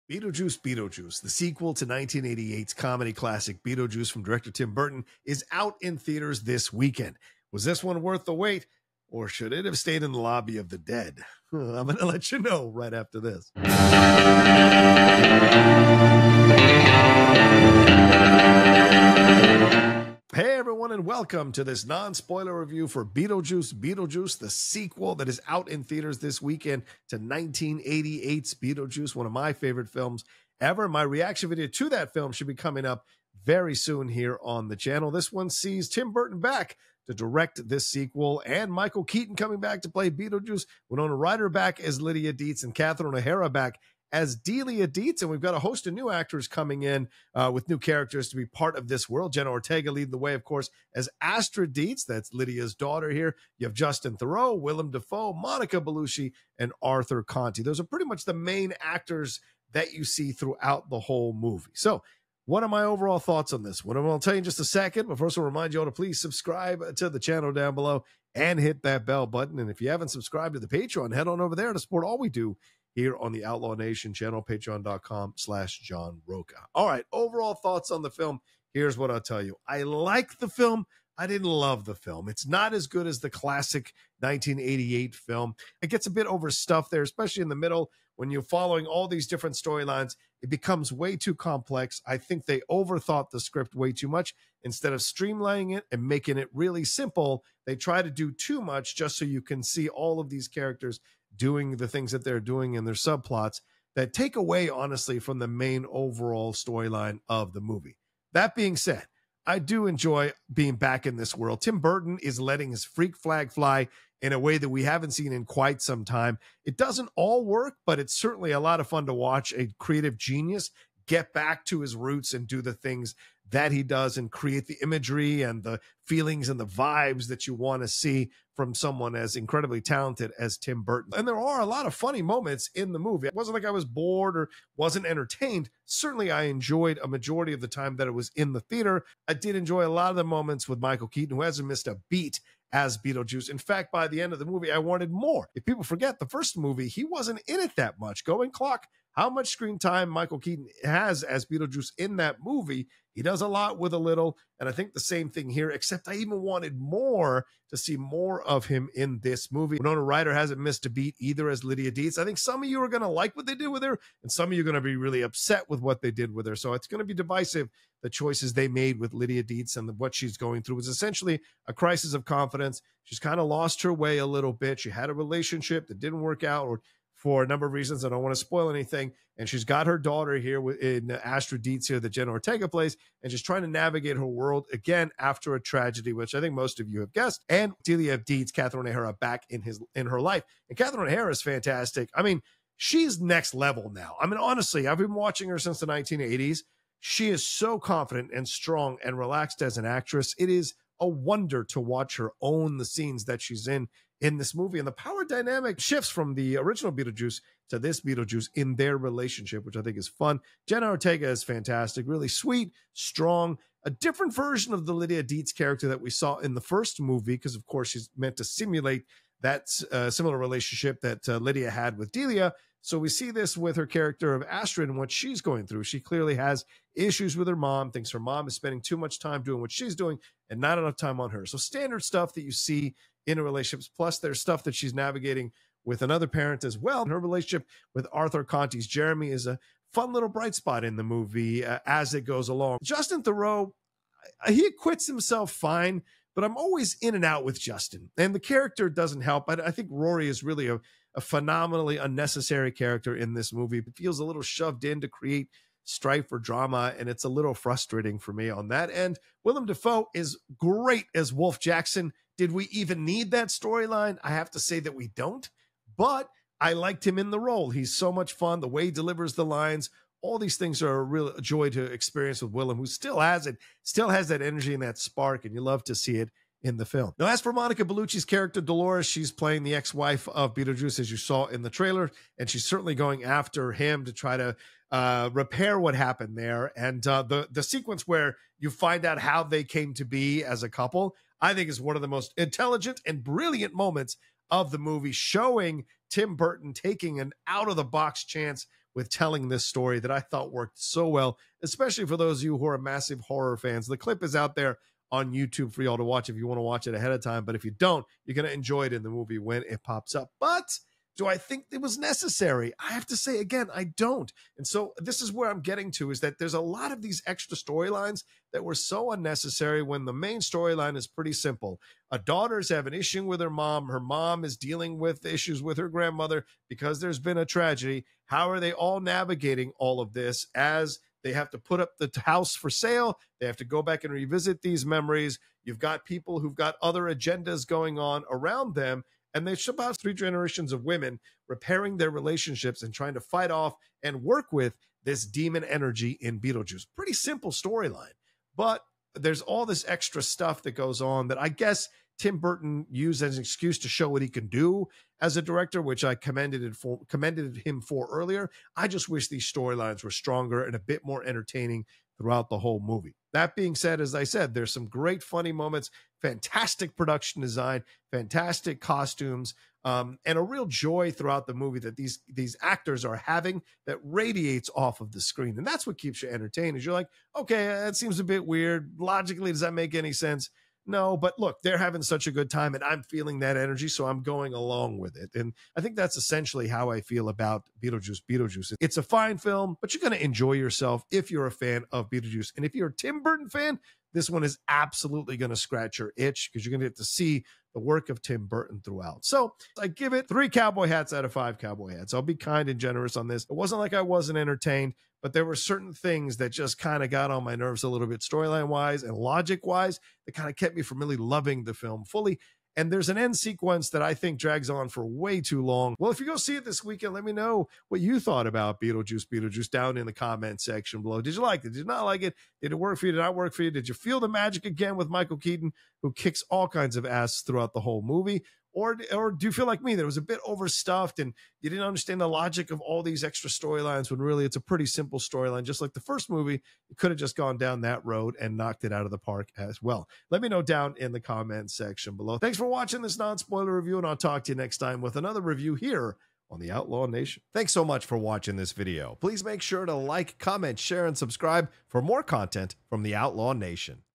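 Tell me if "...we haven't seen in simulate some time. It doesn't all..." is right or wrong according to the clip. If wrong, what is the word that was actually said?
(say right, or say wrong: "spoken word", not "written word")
wrong: "quite", not "simulate".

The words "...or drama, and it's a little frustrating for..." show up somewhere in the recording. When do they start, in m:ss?
4:16.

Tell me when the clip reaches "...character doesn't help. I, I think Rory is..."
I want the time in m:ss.
4:08.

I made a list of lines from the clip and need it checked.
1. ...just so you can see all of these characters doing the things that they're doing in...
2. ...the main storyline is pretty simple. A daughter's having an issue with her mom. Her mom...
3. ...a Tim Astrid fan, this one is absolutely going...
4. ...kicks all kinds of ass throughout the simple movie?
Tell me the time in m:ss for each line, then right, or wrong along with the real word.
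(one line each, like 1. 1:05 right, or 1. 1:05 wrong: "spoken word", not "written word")
1. 1:38 right
2. 5:20 right
3. 6:32 wrong: "Burton", not "Astrid"
4. 7:06 wrong: "whole", not "simple".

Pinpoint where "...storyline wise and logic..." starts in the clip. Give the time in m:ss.
6:48.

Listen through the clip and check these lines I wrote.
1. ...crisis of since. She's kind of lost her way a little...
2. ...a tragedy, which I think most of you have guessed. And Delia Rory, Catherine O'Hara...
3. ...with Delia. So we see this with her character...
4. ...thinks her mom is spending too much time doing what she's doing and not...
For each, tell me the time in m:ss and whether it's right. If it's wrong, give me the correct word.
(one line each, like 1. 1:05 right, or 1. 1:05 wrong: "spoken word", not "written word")
1. 2:51 wrong: "confidence", not "since"
2. 3:05 wrong: "Deetz", not "Rory"
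3. 3:41 right
4. 3:47 right.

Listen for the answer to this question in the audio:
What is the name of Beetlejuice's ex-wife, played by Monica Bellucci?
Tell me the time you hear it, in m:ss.
4:38.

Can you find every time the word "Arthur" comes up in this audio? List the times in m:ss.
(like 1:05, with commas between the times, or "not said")
0:56, 3:58.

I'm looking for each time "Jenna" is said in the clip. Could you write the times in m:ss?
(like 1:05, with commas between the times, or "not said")
0:49, 3:02, 3:30.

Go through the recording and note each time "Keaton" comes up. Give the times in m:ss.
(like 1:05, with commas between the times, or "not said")
0:39, 2:21, 2:30, 7:05.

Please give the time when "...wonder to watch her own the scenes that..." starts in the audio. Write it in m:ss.
3:21.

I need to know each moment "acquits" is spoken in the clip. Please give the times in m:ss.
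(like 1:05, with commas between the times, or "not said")
4:04.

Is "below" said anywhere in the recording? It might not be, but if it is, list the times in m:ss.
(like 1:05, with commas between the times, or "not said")
1:07, 7:01, 7:22.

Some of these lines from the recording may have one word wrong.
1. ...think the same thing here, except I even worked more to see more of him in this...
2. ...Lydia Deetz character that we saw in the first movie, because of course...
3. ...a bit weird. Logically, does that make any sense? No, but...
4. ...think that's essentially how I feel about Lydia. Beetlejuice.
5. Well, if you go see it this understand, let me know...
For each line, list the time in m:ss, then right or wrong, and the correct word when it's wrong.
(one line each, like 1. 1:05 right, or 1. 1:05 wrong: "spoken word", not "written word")
1. 2:34 wrong: "wanted", not "worked"
2. 3:34 right
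3. 6:18 right
4. 6:25 wrong: "Beetlejuice", not "Lydia"
5. 6:55 wrong: "weekend", not "understand".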